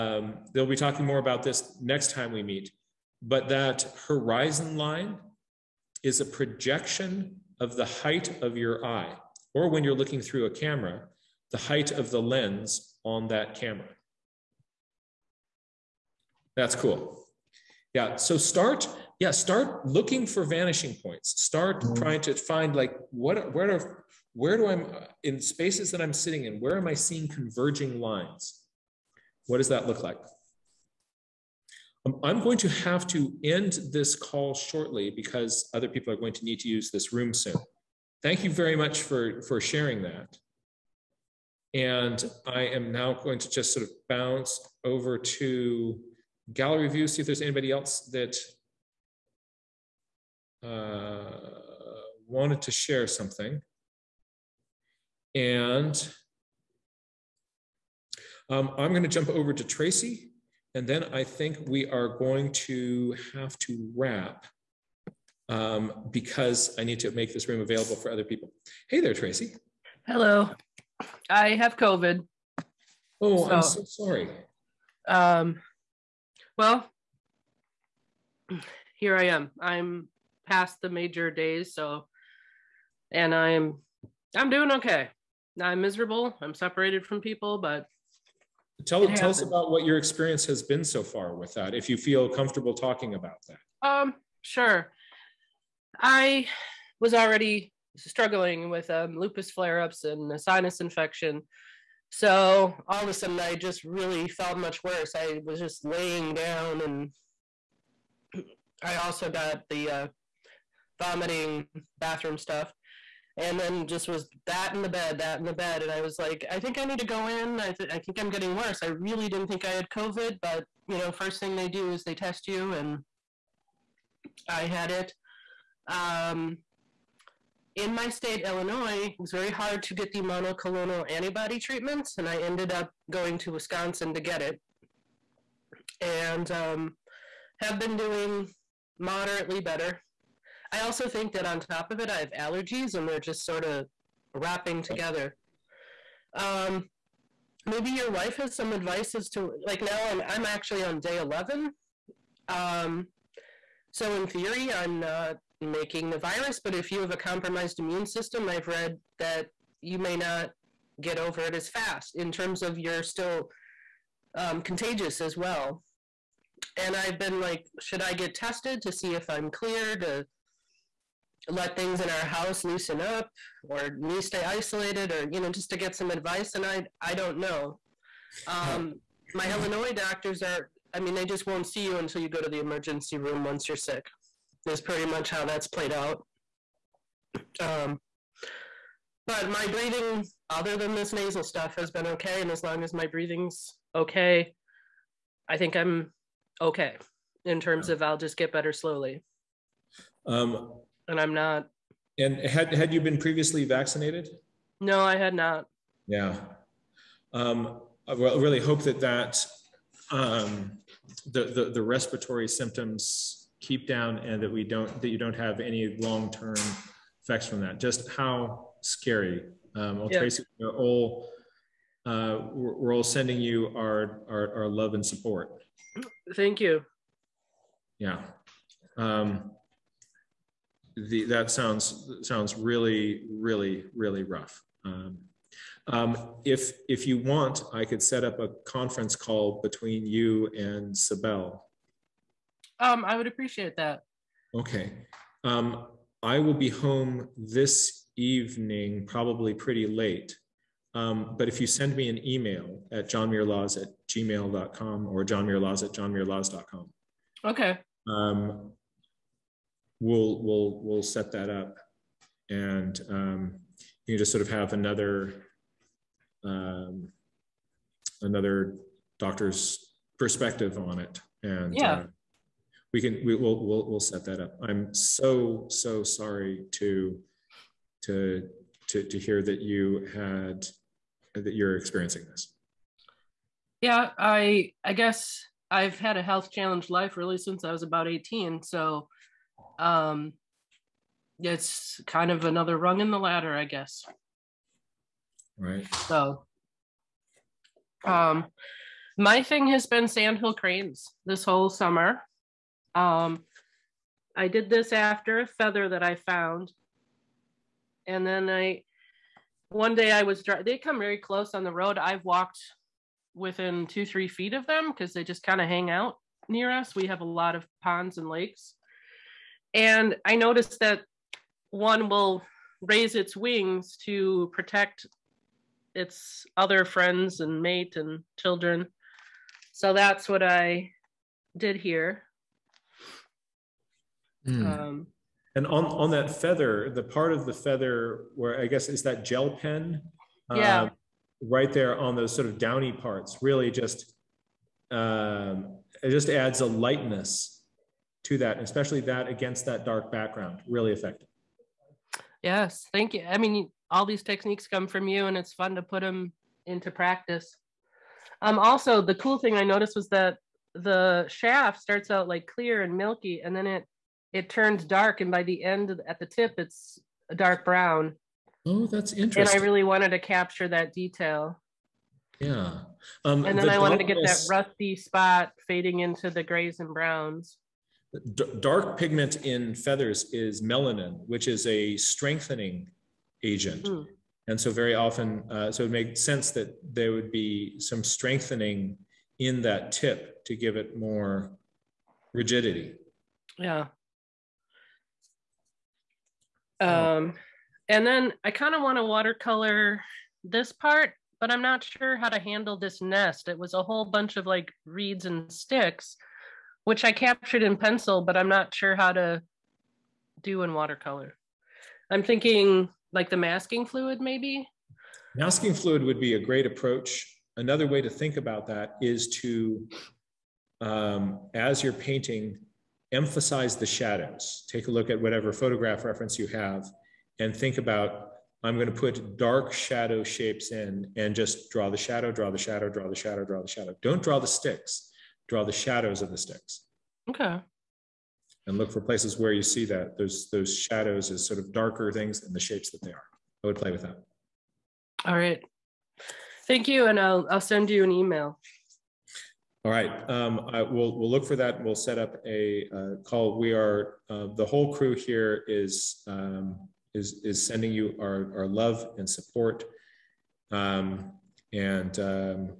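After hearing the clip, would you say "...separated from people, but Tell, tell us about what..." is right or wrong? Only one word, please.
right.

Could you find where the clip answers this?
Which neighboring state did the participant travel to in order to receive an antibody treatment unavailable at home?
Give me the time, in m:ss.
2:13.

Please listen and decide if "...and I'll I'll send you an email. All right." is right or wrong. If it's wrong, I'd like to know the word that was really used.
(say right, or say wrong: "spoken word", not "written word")
right.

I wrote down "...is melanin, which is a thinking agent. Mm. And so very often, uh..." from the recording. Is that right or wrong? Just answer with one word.
wrong.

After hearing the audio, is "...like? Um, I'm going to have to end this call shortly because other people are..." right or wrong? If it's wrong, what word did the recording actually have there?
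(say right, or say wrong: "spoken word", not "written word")
right.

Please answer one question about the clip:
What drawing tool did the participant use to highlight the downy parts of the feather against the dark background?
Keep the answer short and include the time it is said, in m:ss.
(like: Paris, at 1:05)
gel pen, at 5:39.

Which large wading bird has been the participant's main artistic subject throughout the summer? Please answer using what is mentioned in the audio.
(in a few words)
sandhill cranes.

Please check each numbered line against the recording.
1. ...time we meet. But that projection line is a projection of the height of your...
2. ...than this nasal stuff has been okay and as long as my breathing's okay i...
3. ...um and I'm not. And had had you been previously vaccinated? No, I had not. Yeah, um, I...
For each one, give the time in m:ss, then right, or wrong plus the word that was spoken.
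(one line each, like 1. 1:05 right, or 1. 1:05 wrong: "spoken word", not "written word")
1. 0:02 wrong: "horizon", not "projection"
2. 3:10 right
3. 3:20 right.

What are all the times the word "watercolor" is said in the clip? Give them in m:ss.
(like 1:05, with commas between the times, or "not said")
6:39, 6:50.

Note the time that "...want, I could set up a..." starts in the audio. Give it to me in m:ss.
3:57.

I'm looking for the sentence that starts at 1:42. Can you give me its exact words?
So all of a sudden, I just really felt much worse.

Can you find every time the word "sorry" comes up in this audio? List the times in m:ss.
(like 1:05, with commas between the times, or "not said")
1:13, 4:36.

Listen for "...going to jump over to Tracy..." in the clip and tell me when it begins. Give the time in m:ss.
0:58.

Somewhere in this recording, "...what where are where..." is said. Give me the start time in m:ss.
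0:23.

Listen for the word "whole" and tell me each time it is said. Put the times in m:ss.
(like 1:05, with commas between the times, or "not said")
5:01, 6:43, 7:34.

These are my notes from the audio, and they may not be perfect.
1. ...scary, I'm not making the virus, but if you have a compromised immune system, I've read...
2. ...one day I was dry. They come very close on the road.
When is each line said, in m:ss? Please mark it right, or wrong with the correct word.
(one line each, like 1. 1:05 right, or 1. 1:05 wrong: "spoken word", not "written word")
1. 2:34 wrong: "theory", not "scary"
2. 5:09 right.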